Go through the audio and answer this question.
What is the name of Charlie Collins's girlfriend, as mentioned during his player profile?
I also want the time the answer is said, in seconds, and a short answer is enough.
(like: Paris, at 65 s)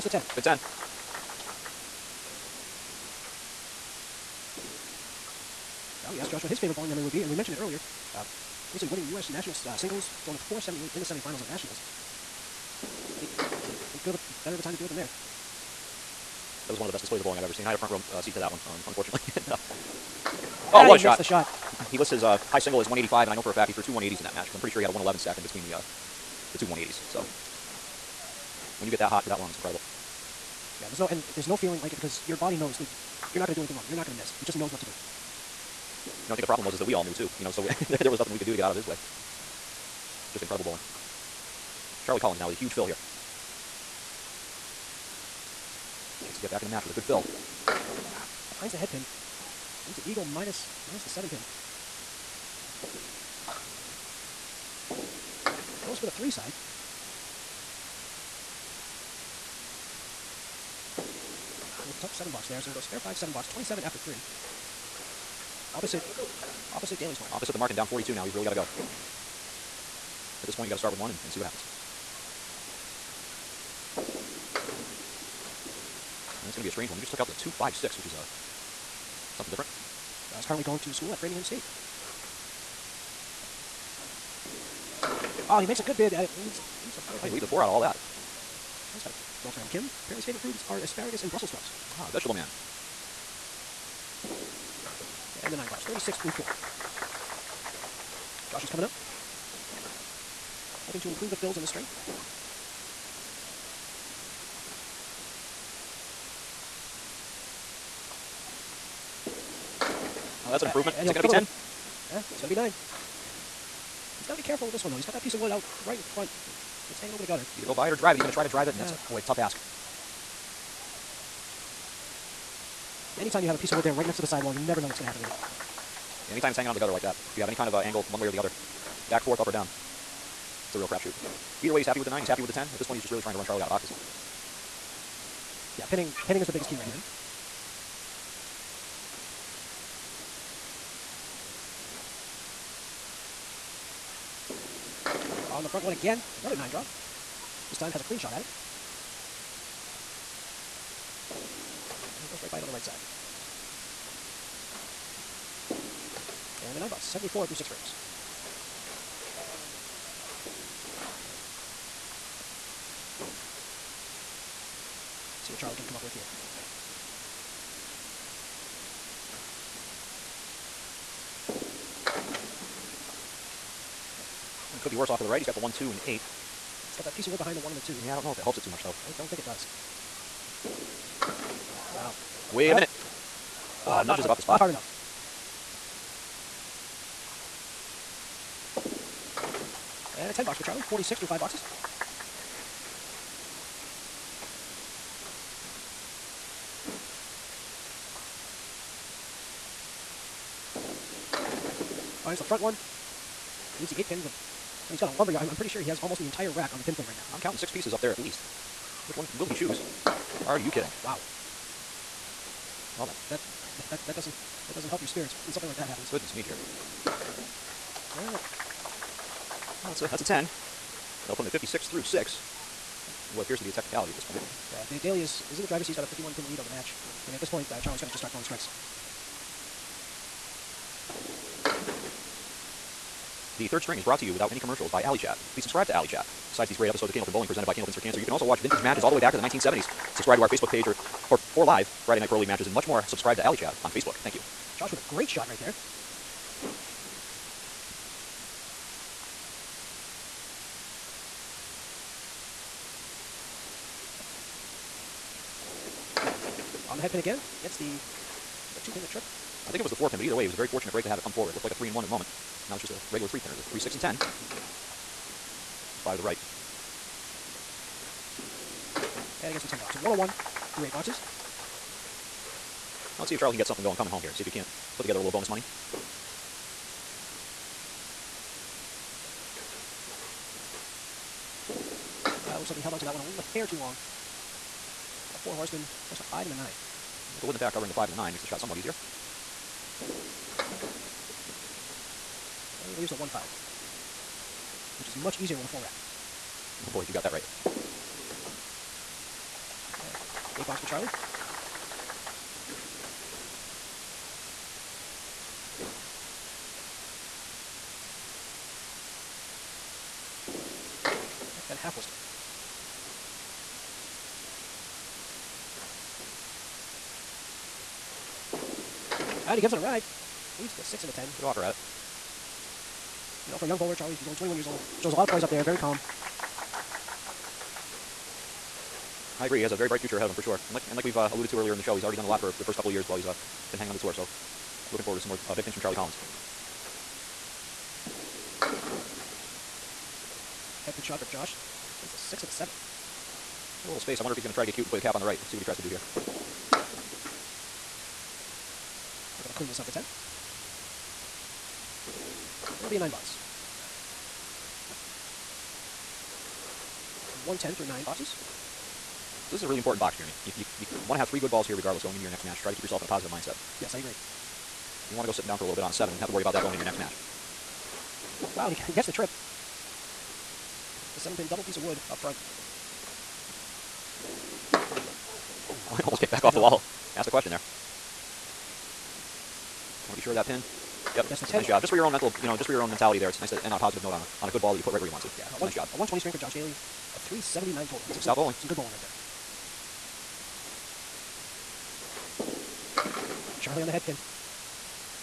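Kim, at 89 s.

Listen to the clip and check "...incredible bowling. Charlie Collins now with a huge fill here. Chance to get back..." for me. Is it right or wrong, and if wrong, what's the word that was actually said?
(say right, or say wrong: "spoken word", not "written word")
right.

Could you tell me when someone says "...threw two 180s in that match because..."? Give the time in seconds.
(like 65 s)
23 s.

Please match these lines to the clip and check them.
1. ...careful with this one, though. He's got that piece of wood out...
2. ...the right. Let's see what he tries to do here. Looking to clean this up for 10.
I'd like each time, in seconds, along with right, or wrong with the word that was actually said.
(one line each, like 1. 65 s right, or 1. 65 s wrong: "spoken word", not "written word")
1. 114 s right
2. 345 s right.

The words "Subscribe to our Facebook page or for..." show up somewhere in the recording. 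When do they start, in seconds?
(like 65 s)
240 s.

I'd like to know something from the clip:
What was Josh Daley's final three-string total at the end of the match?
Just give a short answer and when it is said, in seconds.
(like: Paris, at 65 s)
379, at 387 s.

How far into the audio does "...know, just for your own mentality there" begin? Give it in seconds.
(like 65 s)
382 s.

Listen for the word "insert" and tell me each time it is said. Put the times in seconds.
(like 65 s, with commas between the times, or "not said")
not said.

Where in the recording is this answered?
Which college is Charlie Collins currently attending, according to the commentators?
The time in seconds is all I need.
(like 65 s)
81 s.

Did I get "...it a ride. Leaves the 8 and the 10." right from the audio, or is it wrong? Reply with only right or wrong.
wrong.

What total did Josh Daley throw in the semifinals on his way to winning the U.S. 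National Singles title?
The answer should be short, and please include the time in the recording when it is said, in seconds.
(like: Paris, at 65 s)
478, at 10 s.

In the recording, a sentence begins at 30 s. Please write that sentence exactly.
Yeah, there's no and there's no feeling like it because your body knows that you're not going to do anything wrong.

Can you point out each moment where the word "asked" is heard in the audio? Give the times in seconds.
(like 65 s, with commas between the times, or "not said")
6 s, 377 s.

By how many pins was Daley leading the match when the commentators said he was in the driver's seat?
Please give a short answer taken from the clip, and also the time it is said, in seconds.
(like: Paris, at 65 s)
51, at 226 s.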